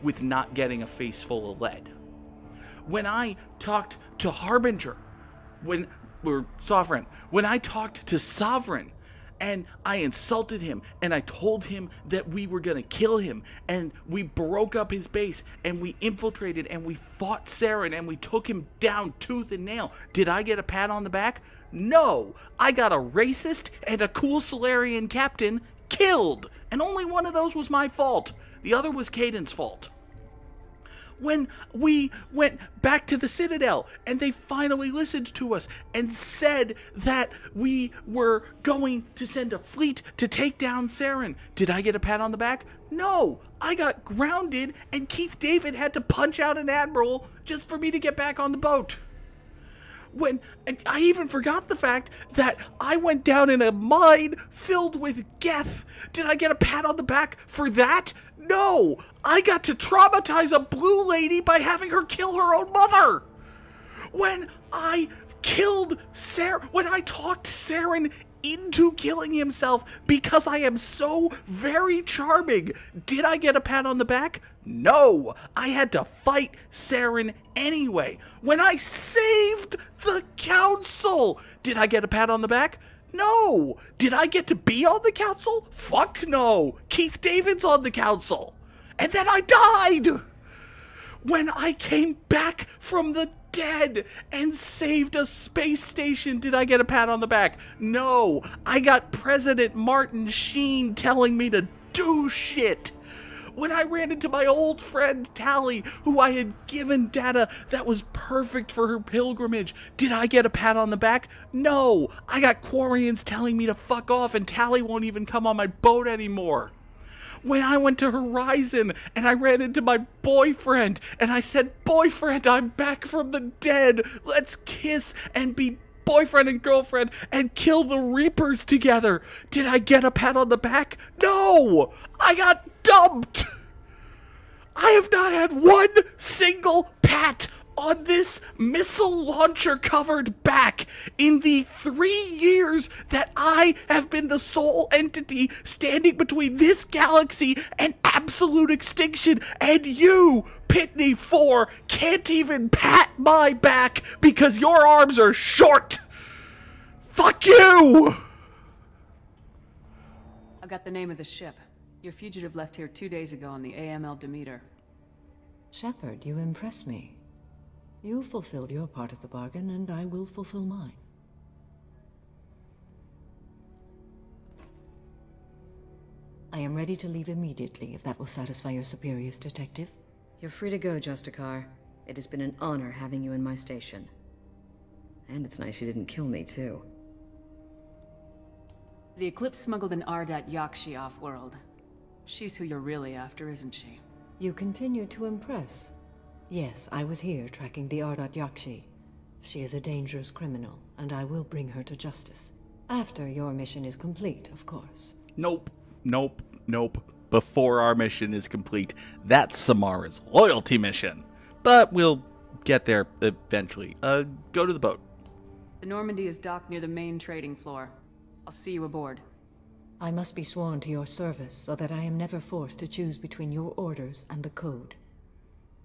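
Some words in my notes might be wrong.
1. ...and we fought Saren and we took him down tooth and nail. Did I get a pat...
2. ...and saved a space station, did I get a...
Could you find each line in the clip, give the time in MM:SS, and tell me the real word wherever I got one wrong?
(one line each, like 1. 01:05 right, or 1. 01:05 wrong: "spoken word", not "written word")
1. 00:16 right
2. 01:34 right.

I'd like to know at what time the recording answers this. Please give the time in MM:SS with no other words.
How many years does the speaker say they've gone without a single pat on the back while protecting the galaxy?
02:21.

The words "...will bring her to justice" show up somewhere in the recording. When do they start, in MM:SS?
03:21.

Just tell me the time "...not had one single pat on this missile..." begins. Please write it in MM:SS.
02:15.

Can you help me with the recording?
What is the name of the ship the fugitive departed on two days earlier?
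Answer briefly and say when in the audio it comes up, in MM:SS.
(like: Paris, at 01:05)
AML Demeter, at 02:43.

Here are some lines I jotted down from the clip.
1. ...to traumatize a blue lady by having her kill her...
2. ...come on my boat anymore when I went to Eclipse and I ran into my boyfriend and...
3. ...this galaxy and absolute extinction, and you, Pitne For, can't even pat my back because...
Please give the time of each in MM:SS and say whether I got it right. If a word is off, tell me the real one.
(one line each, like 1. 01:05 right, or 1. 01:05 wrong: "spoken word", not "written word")
1. 00:59 right
2. 01:55 wrong: "Horizon", not "Eclipse"
3. 02:26 right.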